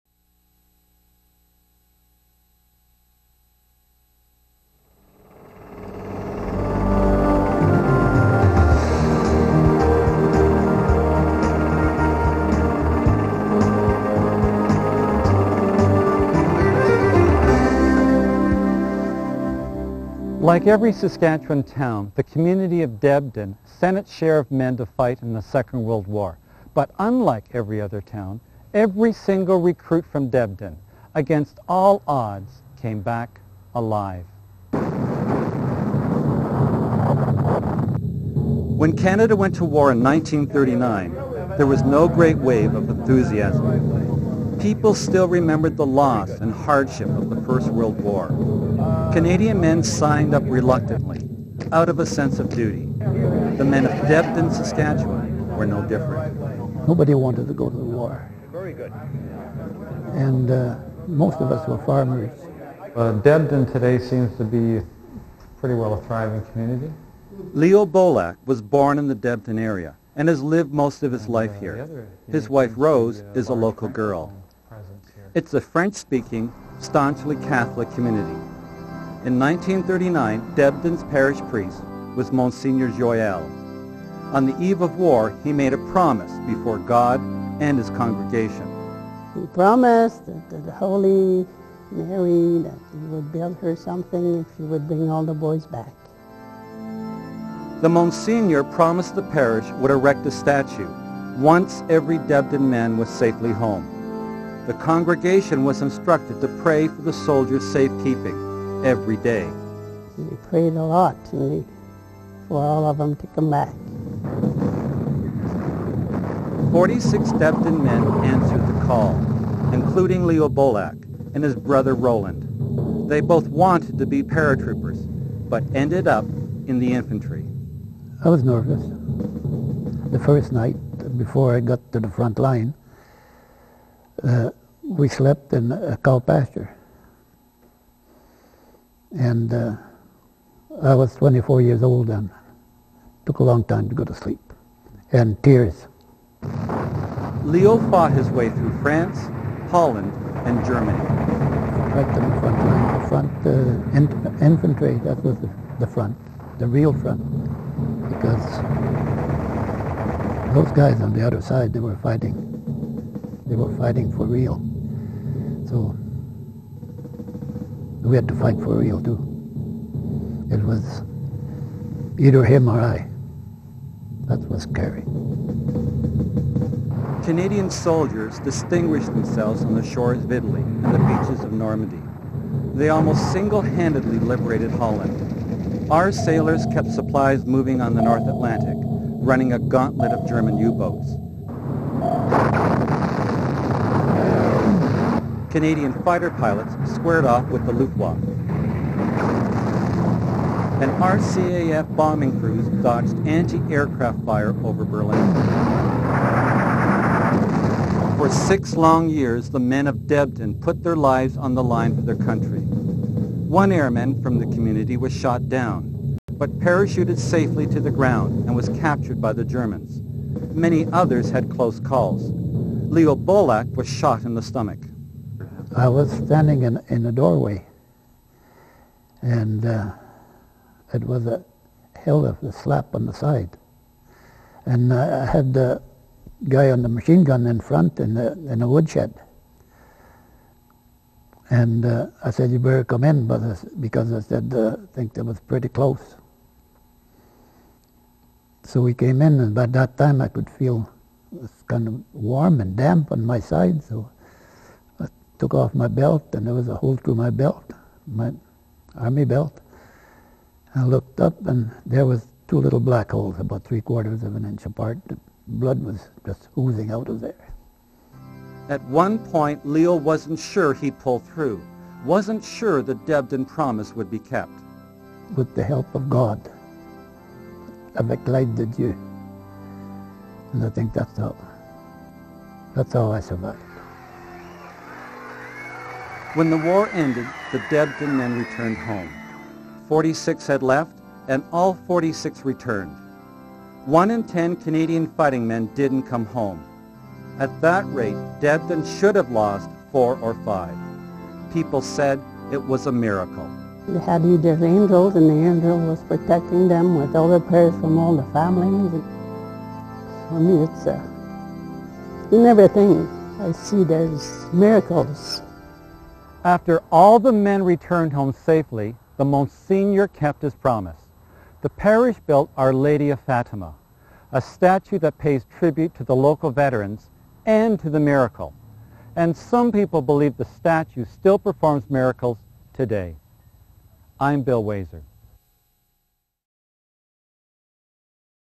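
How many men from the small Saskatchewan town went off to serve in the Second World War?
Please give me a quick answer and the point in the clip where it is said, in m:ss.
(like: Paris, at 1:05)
46, at 1:56.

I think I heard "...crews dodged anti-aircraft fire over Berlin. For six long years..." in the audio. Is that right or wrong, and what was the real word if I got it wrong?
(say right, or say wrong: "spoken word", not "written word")
right.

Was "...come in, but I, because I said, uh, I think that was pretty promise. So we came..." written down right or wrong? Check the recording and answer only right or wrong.
wrong.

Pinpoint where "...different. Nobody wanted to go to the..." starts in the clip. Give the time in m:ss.
0:55.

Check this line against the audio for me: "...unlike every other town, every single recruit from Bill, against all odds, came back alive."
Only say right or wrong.
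wrong.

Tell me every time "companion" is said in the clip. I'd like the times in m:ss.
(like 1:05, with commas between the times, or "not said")
not said.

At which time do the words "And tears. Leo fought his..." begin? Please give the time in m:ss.
2:25.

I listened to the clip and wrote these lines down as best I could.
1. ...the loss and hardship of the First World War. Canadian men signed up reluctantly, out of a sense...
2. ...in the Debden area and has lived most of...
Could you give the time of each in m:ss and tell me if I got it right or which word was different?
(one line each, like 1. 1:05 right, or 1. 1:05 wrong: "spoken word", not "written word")
1. 0:45 right
2. 1:08 right.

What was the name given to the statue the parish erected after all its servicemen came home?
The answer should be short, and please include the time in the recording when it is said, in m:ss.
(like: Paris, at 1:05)
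Our Lady of Fatima, at 5:22.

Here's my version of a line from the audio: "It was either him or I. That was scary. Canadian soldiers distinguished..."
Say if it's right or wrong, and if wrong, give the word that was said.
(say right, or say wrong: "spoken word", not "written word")
right.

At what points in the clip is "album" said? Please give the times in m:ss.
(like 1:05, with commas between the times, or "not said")
not said.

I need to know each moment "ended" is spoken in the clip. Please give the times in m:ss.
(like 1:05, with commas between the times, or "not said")
2:05, 4:46.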